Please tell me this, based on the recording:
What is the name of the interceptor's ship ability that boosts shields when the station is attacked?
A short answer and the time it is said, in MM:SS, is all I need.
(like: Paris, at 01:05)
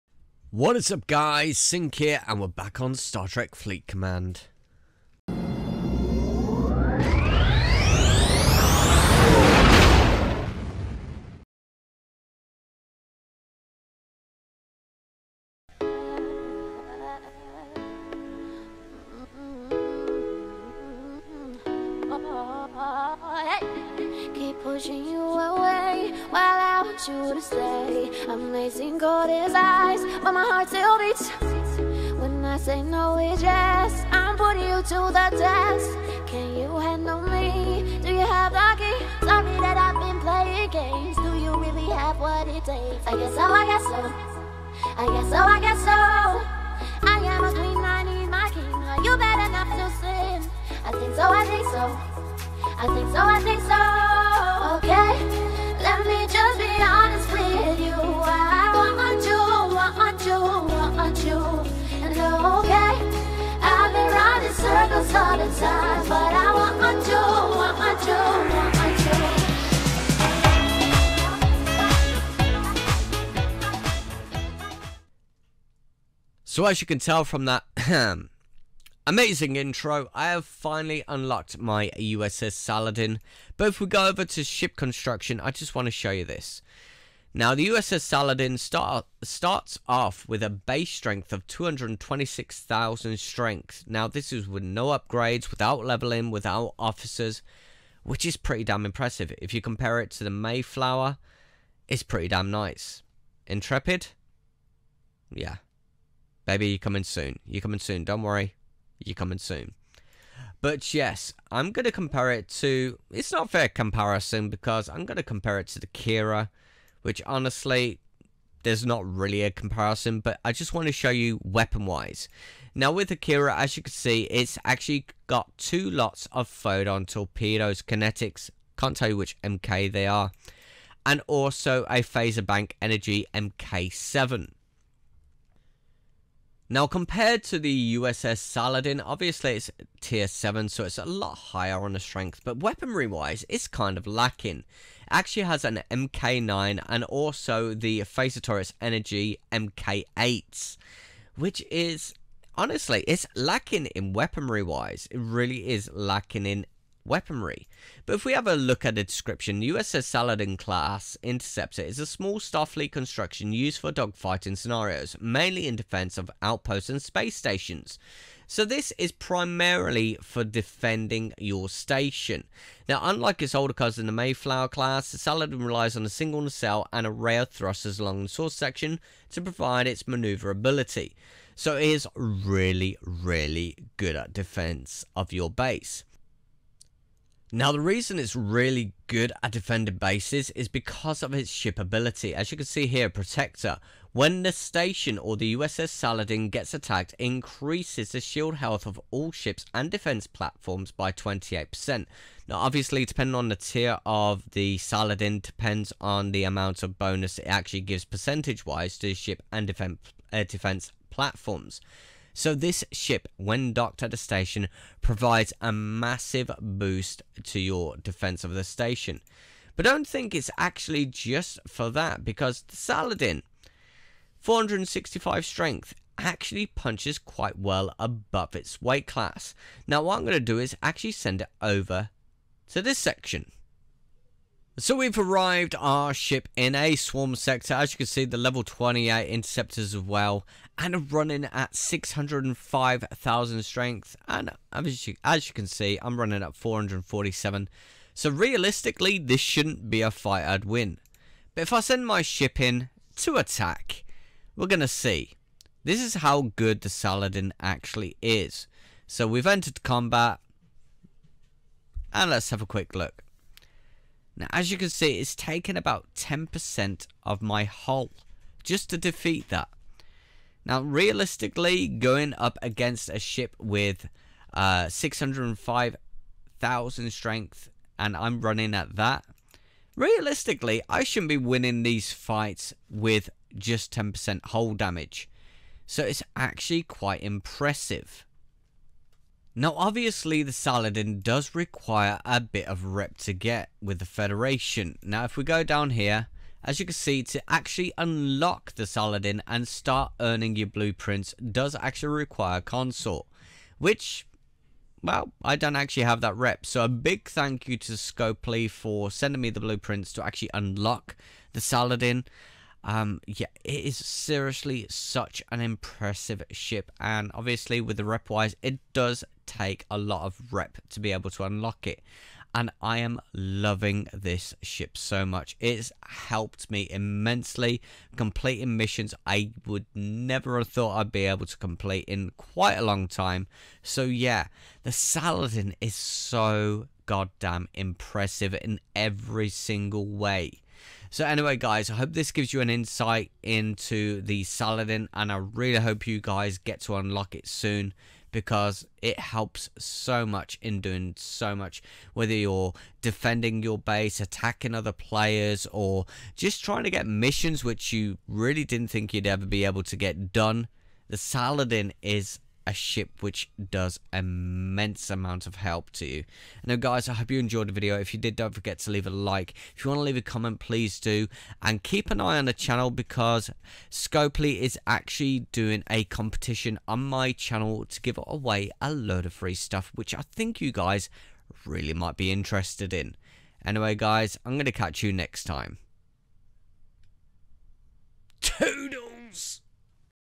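Protector, at 03:13.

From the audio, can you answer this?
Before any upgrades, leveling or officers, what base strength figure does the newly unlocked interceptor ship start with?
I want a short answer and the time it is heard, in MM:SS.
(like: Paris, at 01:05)
226,000, at 01:31.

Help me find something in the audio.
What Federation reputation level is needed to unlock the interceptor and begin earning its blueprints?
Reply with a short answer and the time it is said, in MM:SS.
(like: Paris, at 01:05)
Consort, at 05:02.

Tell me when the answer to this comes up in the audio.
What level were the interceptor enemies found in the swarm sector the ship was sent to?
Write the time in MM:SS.
03:58.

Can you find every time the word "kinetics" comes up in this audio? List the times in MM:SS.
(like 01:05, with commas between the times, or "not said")
02:07.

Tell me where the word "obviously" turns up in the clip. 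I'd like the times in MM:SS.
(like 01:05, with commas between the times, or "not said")
02:19, 03:22, 04:49, 05:17.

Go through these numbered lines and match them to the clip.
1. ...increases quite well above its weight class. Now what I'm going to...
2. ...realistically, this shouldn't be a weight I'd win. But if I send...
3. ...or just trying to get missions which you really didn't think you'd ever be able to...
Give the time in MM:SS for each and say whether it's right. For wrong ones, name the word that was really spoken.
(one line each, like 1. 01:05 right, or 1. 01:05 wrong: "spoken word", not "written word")
1. 03:46 wrong: "punches", not "increases"
2. 04:08 wrong: "fight", not "weight"
3. 05:55 right.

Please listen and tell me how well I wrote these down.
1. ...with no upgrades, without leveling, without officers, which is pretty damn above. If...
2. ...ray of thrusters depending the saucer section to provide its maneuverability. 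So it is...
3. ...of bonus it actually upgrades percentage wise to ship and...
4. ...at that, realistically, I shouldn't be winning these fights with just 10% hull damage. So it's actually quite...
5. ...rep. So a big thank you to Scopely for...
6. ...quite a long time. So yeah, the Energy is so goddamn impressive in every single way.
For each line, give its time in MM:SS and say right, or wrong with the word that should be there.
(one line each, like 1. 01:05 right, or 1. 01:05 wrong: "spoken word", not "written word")
1. 01:34 wrong: "impressive", not "above"
2. 02:57 wrong: "along", not "depending"
3. 03:26 wrong: "gives", not "upgrades"
4. 04:38 right
5. 05:06 right
6. 05:32 wrong: "Saladin", not "Energy".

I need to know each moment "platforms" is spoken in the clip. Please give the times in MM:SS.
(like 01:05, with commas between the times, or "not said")
03:20, 03:31.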